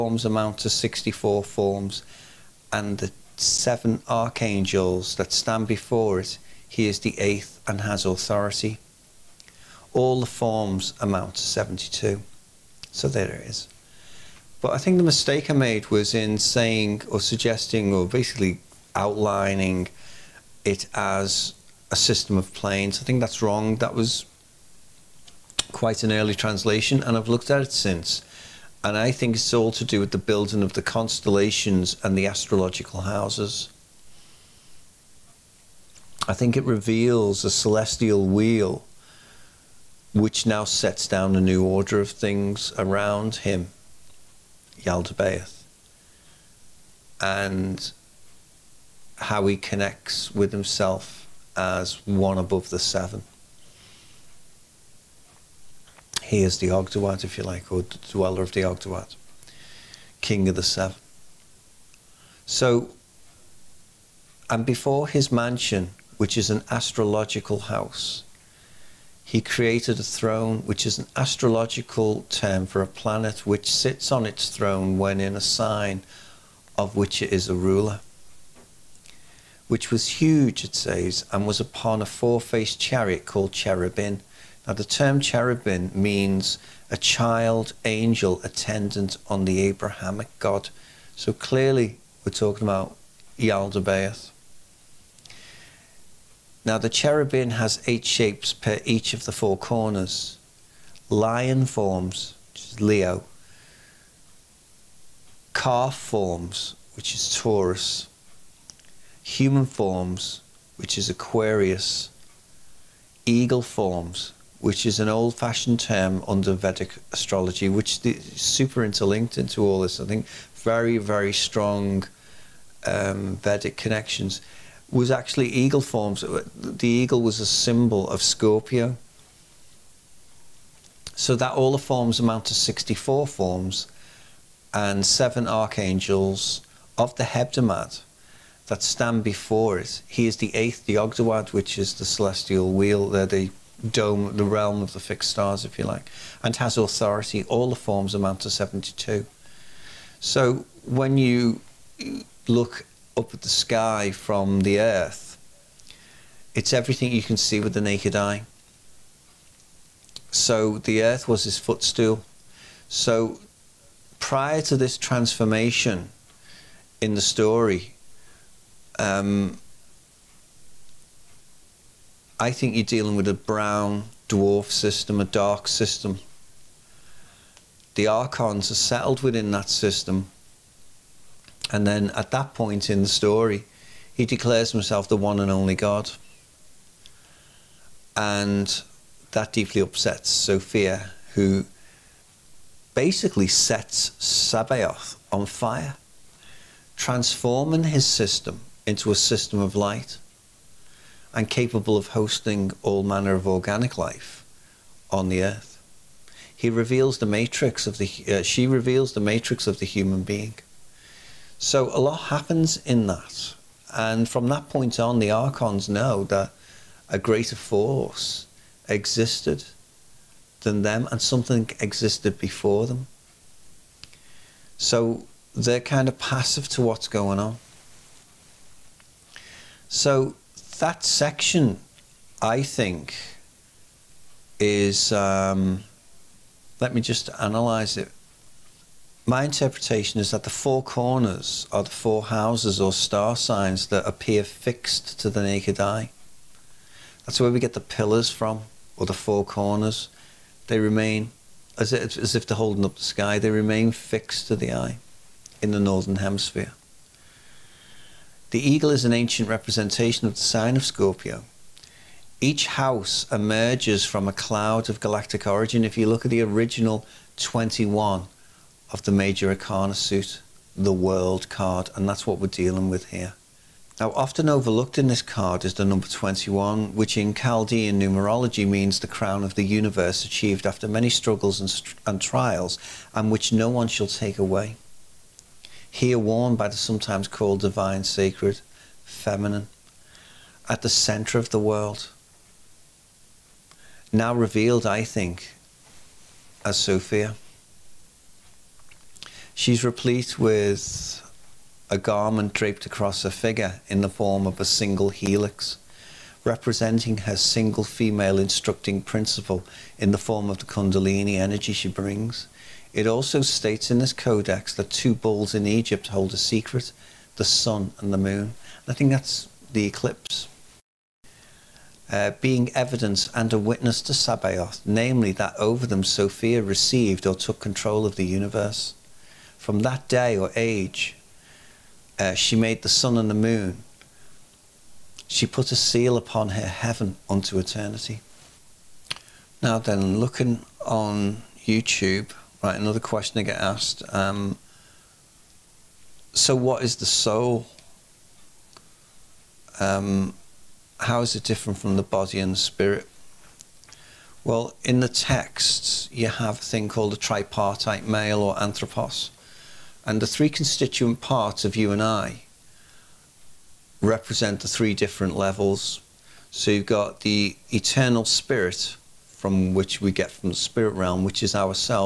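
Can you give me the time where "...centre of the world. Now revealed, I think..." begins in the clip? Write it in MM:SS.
04:50.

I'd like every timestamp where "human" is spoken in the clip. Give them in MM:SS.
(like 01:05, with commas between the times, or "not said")
01:49, 03:29.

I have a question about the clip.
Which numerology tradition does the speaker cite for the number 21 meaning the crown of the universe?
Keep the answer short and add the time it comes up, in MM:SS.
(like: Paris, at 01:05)
Chaldean, at 04:37.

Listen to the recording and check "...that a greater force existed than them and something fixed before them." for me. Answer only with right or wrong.
wrong.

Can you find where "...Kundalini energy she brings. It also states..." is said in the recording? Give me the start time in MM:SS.
05:10.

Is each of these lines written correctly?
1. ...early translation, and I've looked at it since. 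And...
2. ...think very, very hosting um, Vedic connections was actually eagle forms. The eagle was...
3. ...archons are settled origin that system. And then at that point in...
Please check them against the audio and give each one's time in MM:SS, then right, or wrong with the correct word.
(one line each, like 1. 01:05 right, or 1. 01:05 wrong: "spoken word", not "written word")
1. 00:26 right
2. 02:00 wrong: "strong", not "hosting"
3. 02:58 wrong: "within", not "origin".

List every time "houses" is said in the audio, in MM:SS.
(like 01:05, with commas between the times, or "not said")
00:33, 01:07, 04:02, 04:22.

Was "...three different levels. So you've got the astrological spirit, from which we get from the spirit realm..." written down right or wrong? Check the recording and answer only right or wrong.
wrong.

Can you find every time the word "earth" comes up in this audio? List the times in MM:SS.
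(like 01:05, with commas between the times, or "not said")
02:34, 02:41, 03:25.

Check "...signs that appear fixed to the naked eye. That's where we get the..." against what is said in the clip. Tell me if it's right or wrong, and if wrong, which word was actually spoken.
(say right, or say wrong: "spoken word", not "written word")
right.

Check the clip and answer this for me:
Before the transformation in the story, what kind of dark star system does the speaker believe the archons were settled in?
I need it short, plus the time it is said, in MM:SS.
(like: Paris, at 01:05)
A brown dwarf system, at 02:53.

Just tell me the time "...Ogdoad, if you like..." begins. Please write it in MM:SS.
00:56.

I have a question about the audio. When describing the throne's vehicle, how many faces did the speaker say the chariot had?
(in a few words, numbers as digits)
4.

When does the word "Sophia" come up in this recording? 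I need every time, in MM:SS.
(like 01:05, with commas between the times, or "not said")
03:10, 04:56, 05:26.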